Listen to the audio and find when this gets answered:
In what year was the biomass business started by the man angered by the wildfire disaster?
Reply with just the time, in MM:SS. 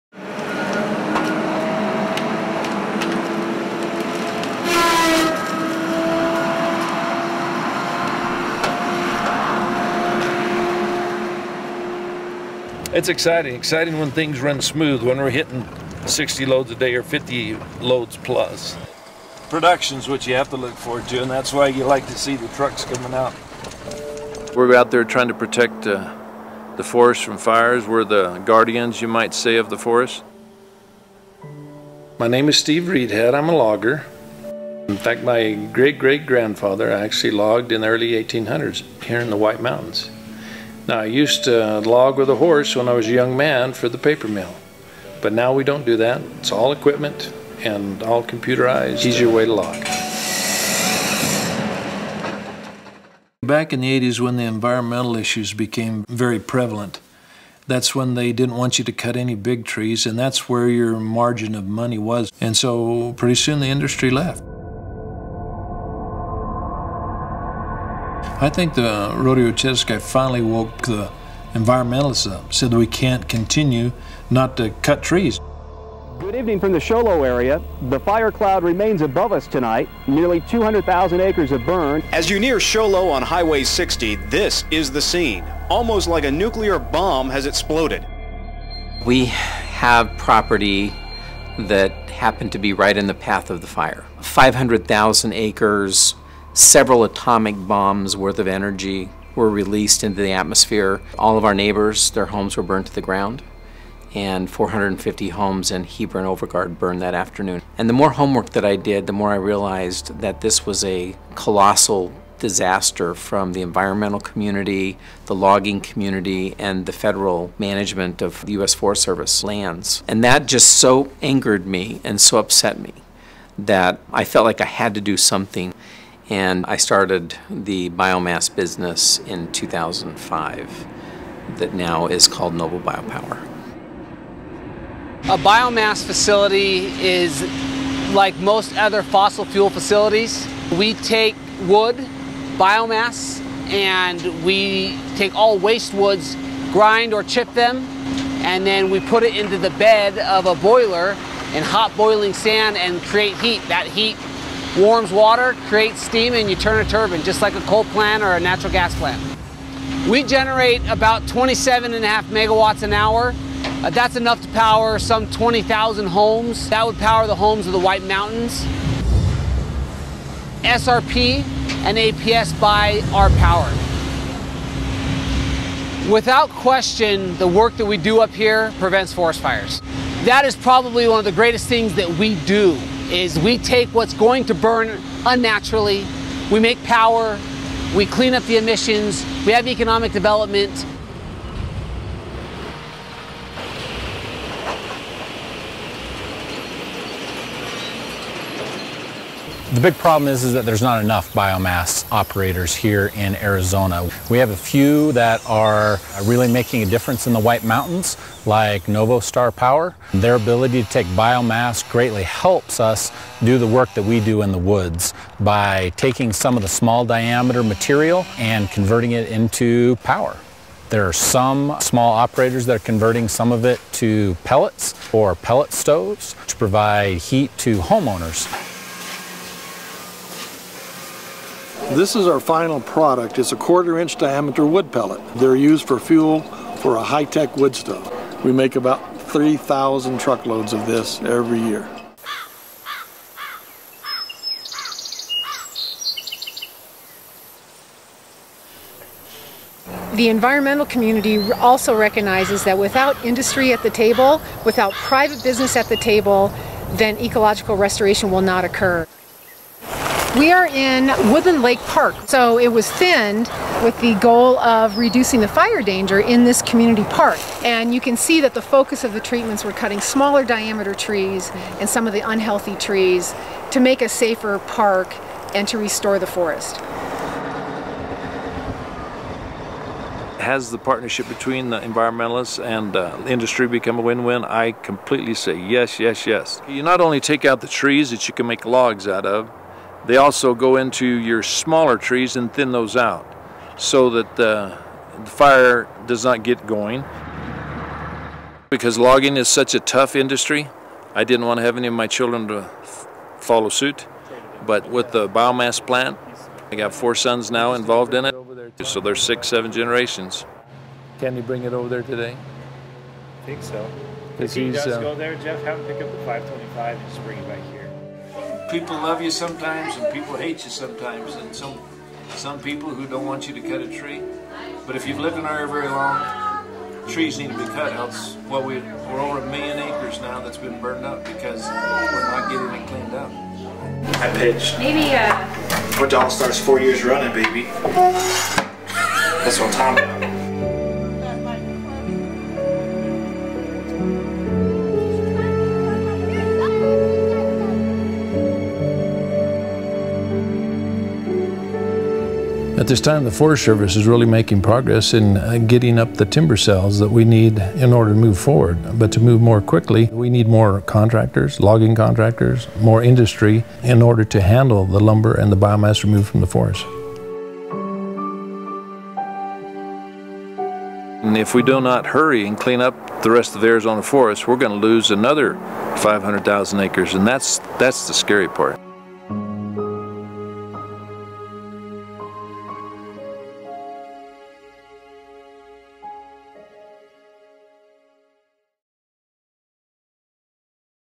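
02:09.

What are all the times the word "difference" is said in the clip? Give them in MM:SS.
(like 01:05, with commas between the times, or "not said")
03:26.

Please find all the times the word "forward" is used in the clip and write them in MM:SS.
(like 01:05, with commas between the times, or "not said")
00:20, 05:58.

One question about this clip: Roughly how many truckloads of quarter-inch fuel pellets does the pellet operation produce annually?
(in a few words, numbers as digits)
3,000.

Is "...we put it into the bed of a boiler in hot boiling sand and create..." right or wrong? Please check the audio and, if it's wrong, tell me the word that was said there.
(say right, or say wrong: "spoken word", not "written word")
right.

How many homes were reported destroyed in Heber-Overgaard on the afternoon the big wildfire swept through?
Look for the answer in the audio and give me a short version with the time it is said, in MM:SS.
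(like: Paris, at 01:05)
450, at 01:44.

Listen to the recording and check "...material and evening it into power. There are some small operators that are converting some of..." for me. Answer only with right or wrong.
wrong.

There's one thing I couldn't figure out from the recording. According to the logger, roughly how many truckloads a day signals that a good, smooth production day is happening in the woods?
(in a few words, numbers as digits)
60.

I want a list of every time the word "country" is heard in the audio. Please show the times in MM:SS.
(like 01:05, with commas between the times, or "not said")
not said.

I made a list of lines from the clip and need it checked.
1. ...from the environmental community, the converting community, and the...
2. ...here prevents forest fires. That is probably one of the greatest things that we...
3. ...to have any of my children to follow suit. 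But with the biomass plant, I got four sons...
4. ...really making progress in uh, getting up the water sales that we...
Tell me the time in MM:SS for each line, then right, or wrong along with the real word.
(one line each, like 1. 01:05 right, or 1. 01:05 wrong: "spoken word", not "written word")
1. 01:53 wrong: "logging", not "converting"
2. 02:58 right
3. 05:01 right
4. 05:54 wrong: "timber", not "water".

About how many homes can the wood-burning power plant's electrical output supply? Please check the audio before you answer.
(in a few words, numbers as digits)
20,000.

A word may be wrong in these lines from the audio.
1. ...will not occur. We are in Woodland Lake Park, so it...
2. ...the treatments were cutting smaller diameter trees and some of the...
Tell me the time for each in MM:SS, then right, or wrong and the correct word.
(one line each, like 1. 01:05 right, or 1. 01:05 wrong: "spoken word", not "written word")
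1. 04:18 right
2. 04:29 right.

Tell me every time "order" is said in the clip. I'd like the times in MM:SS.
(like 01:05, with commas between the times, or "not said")
05:57, 06:04.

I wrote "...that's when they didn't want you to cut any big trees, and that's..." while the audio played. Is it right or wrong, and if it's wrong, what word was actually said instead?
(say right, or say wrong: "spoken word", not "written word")
right.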